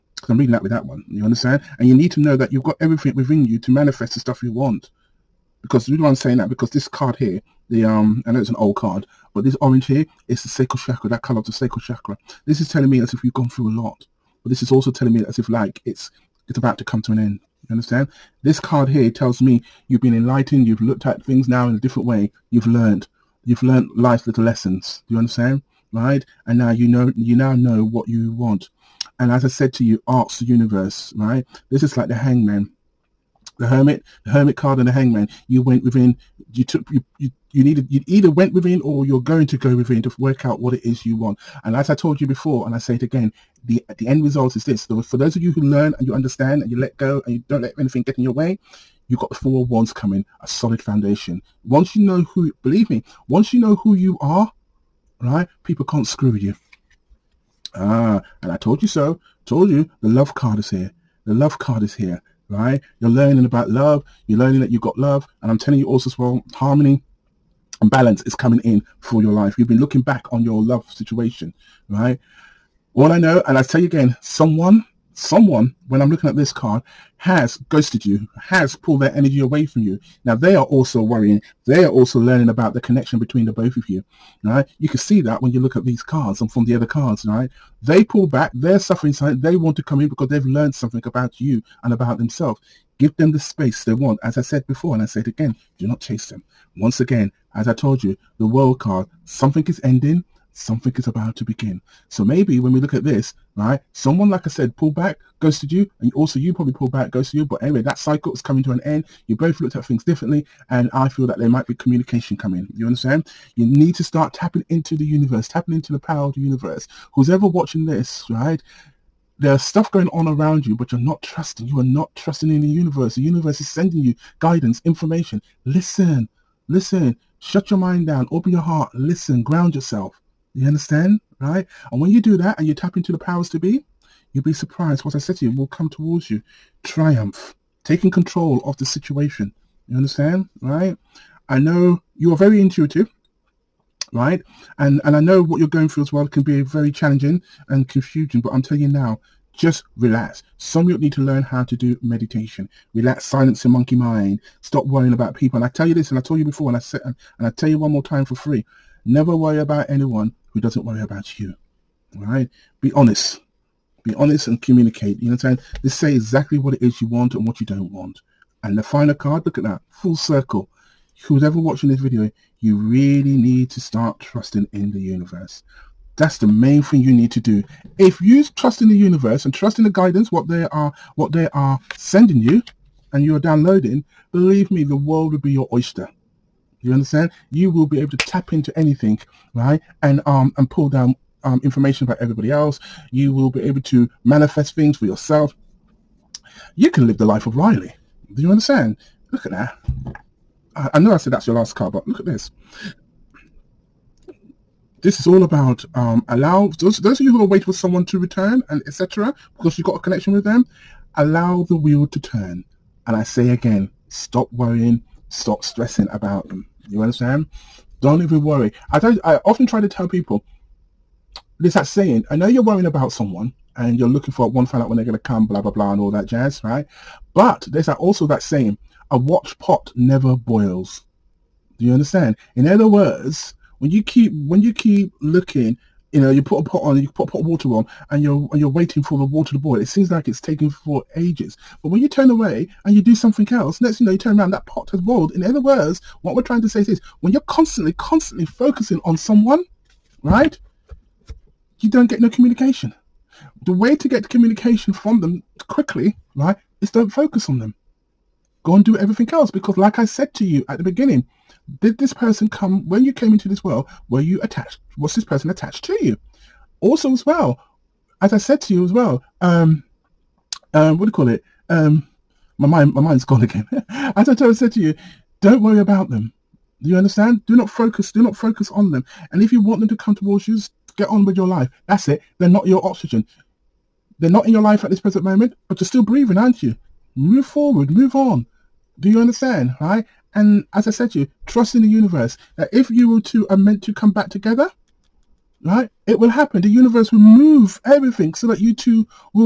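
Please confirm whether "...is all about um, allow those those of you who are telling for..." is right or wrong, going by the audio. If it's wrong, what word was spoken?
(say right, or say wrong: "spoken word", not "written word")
wrong: "waiting", not "telling".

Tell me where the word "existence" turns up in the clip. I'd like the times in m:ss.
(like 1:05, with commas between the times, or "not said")
not said.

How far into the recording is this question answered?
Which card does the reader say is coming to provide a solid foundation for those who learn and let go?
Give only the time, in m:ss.
0:49.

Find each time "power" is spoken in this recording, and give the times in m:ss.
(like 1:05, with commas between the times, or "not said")
1:55, 2:13.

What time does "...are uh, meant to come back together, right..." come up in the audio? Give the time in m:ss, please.
4:53.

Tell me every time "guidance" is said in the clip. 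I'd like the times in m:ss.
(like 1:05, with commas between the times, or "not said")
2:04, 2:59.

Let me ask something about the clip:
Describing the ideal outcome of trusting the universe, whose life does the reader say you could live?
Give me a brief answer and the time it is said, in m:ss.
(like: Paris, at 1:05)
Riley, at 3:17.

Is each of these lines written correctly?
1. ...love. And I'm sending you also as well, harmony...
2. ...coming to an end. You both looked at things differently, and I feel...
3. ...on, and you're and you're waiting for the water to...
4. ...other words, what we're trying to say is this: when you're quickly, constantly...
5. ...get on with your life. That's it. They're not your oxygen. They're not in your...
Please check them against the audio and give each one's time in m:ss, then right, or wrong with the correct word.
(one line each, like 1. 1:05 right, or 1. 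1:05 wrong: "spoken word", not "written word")
1. 1:04 wrong: "telling", not "sending"
2. 1:48 right
3. 3:57 right
4. 4:05 wrong: "constantly", not "quickly"
5. 4:40 right.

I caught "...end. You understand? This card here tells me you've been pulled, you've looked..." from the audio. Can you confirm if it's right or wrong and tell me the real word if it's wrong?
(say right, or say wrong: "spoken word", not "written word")
wrong: "enlightened", not "pulled".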